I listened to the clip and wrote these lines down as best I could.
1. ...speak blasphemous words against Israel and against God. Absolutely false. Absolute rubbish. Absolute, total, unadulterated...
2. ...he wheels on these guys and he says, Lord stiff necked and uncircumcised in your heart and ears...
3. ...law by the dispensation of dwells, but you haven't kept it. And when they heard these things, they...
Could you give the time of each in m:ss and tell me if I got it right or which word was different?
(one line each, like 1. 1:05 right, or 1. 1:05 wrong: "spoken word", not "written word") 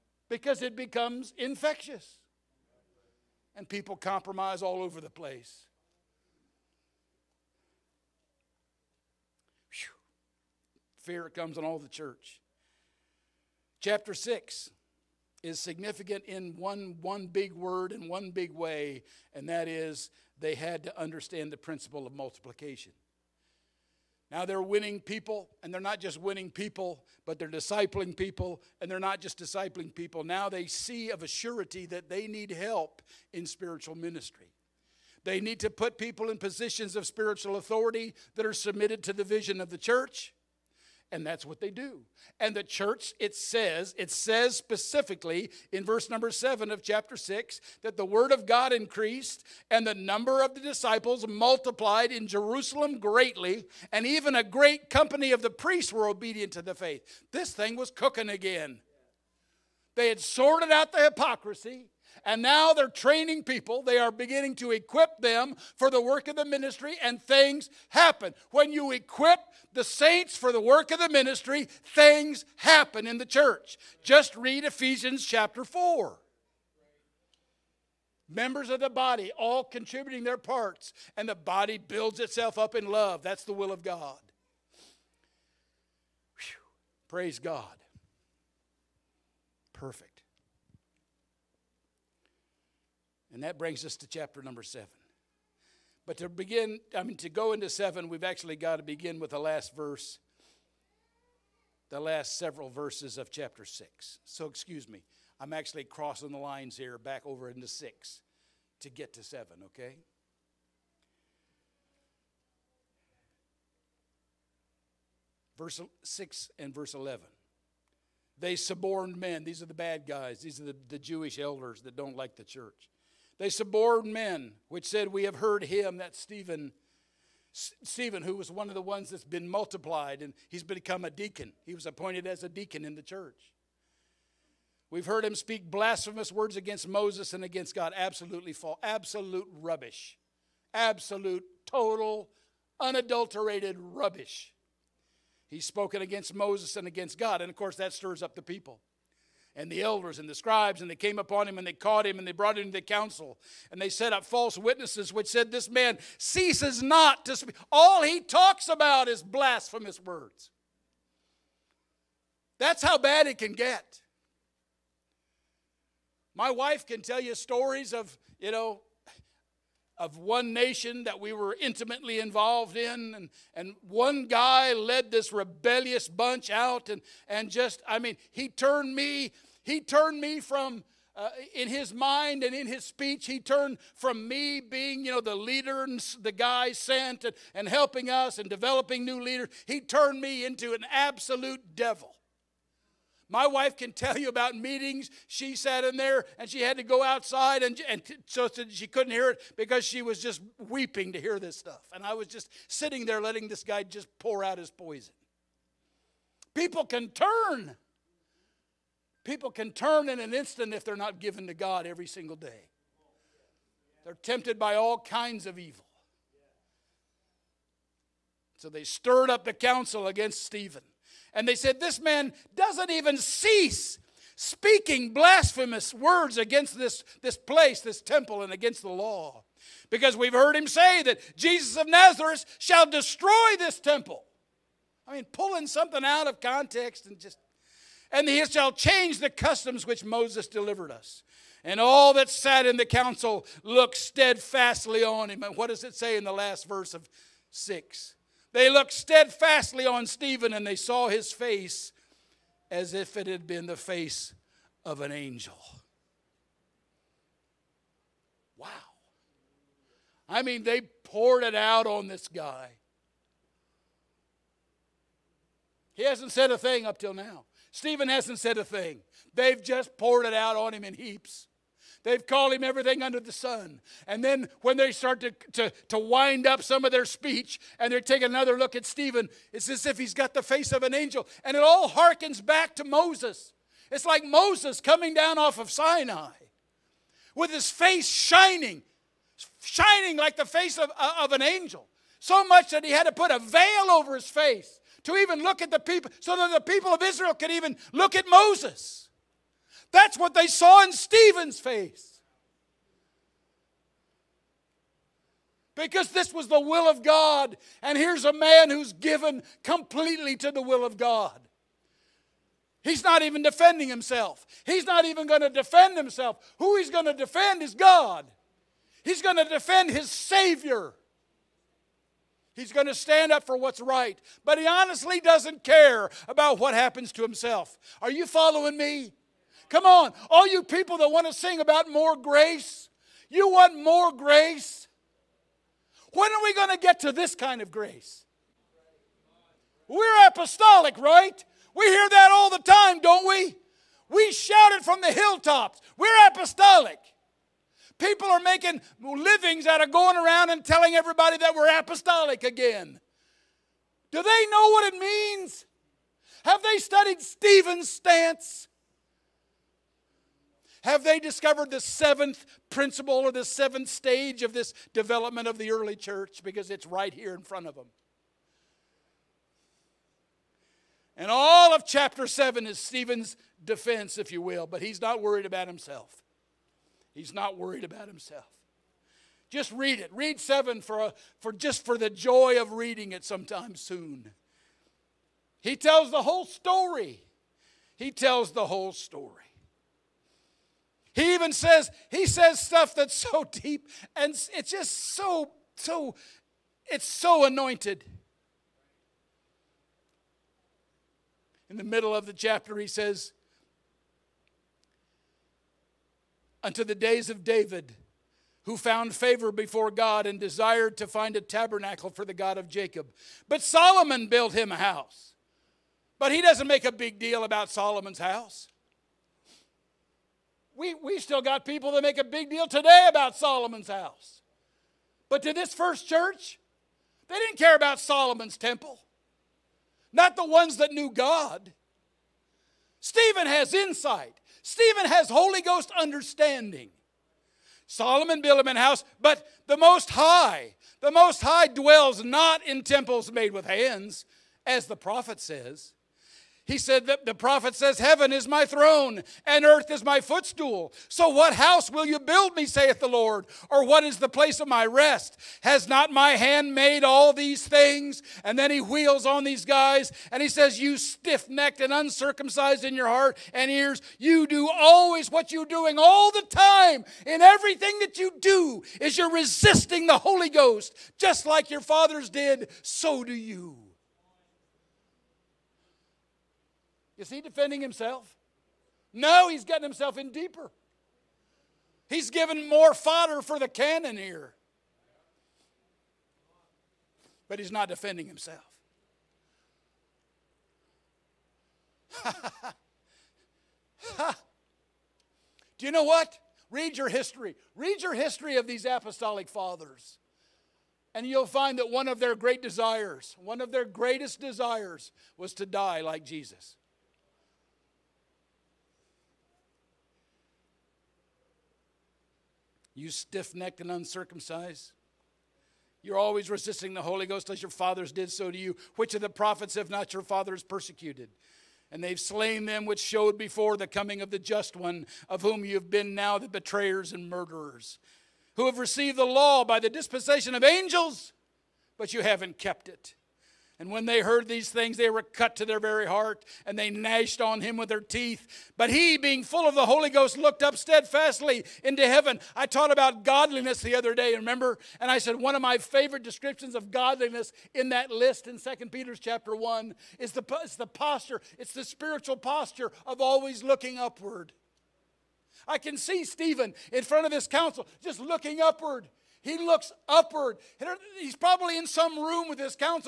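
1. 2:15 wrong: "Moses", not "Israel"
2. 7:38 wrong: "You", not "Lord"
3. 8:49 wrong: "angels", not "dwells".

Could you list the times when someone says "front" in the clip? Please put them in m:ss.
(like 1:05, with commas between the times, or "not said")
6:07, 9:17.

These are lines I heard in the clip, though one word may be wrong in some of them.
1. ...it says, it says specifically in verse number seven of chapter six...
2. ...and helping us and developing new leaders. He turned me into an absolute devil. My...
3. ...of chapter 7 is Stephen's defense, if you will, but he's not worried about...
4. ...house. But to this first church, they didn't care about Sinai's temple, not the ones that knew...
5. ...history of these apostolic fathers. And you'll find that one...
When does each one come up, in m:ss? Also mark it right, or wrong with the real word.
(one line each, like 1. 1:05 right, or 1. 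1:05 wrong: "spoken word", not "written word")
1. 0:43 right
2. 3:07 right
3. 6:11 right
4. 7:03 wrong: "Solomon", not "Sinai"
5. 8:18 right.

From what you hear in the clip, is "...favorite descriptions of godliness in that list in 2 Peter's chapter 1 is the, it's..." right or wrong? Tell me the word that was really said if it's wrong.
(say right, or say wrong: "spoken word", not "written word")
right.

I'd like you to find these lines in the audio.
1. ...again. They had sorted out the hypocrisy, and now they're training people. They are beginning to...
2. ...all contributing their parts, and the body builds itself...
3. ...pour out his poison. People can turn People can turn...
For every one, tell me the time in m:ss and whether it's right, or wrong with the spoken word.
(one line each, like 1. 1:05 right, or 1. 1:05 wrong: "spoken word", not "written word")
1. 0:58 right
2. 1:19 right
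3. 3:24 right.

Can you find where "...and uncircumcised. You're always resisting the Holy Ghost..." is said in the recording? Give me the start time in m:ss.
8:33.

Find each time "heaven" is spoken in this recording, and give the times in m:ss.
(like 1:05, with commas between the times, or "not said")
7:27, 9:02.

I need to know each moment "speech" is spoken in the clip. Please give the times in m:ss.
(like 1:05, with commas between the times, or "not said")
3:02, 4:37.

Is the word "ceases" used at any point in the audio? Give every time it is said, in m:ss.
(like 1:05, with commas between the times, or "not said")
2:36, 3:43.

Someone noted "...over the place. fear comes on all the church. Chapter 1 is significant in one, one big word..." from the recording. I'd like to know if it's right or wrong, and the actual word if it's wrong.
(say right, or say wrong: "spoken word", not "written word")
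wrong: "6", not "1".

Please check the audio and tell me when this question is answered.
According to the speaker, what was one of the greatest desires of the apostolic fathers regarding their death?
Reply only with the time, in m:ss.
8:25.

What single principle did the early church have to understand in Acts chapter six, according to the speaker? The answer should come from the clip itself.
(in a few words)
multiplication.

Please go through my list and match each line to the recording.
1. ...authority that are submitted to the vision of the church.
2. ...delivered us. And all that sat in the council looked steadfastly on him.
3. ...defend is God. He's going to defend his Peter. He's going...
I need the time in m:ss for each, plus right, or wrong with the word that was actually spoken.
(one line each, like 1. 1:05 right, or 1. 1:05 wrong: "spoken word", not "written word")
1. 0:37 right
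2. 4:00 right
3. 5:17 wrong: "Savior", not "Peter".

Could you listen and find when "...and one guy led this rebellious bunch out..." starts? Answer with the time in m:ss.
2:53.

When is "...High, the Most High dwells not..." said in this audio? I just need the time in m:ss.
7:20.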